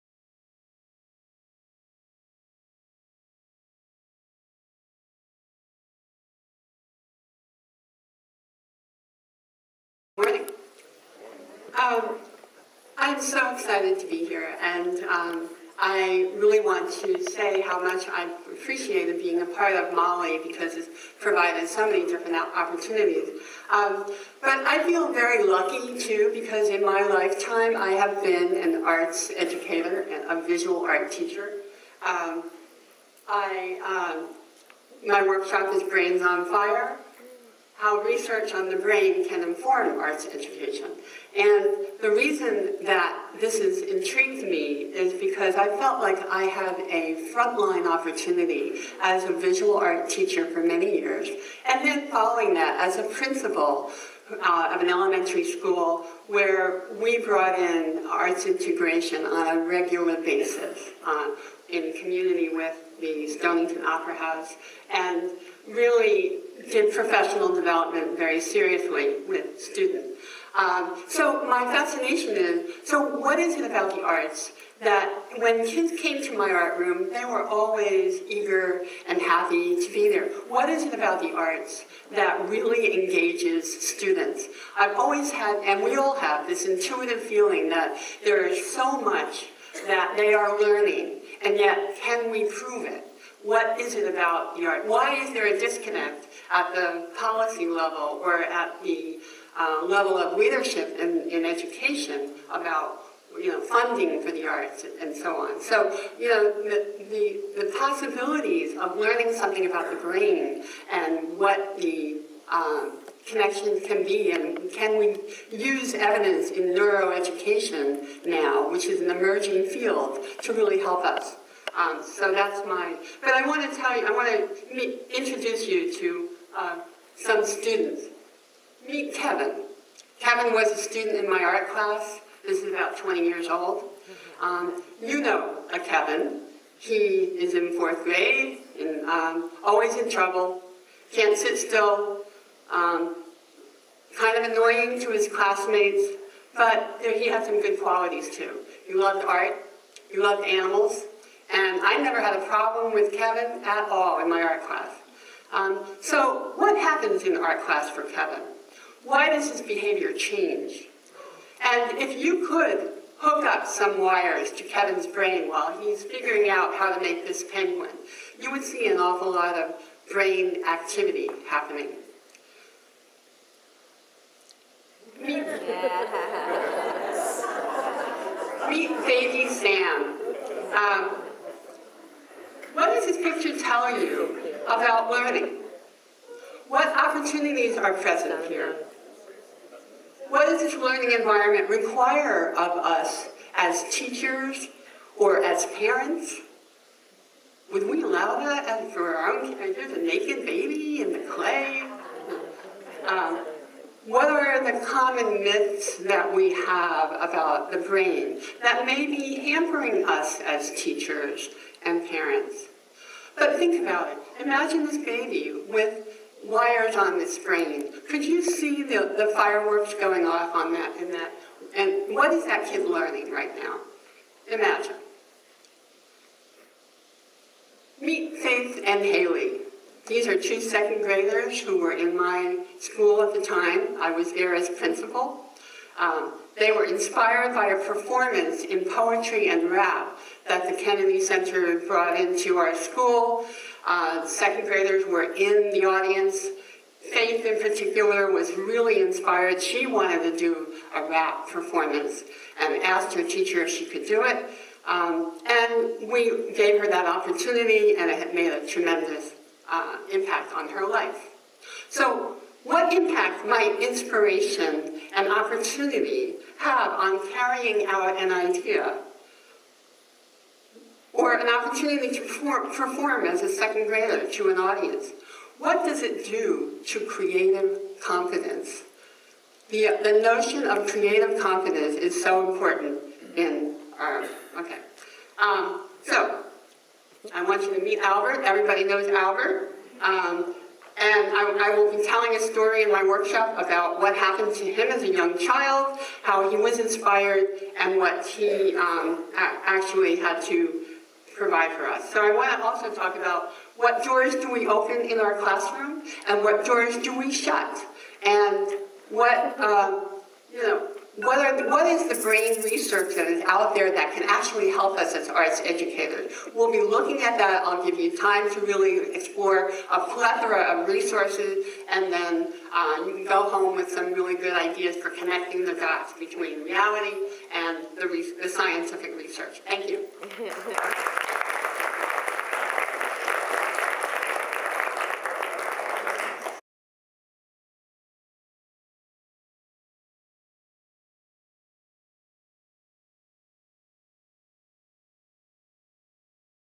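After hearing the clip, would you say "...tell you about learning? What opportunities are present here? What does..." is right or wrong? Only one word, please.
right.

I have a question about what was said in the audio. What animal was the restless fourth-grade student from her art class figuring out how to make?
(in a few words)
Penguin.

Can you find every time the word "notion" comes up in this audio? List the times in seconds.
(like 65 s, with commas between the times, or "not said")
280 s.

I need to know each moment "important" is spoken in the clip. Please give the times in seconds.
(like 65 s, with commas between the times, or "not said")
282 s.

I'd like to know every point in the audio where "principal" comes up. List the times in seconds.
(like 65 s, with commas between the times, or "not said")
53 s, 234 s.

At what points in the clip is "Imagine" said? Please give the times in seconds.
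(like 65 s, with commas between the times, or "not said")
214 s, 224 s.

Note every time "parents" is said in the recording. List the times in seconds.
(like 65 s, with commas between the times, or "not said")
195 s, 212 s.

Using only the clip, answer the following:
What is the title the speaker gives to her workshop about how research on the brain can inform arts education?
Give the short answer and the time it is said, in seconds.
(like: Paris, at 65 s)
Brains on Fire, at 35 s.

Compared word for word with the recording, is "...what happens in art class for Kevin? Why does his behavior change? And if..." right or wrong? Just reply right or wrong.
right.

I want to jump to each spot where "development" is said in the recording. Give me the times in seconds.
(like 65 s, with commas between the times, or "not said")
67 s.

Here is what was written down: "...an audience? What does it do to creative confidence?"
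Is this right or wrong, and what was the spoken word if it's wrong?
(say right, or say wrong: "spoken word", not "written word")
right.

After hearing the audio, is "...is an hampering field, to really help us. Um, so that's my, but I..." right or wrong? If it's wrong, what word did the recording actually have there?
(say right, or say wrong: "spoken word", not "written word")
wrong: "emerging", not "hampering".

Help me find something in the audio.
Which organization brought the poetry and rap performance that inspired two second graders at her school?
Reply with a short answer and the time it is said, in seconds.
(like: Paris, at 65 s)
Kennedy Center, at 240 s.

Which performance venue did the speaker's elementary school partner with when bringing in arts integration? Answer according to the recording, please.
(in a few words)
Stonington Opera House.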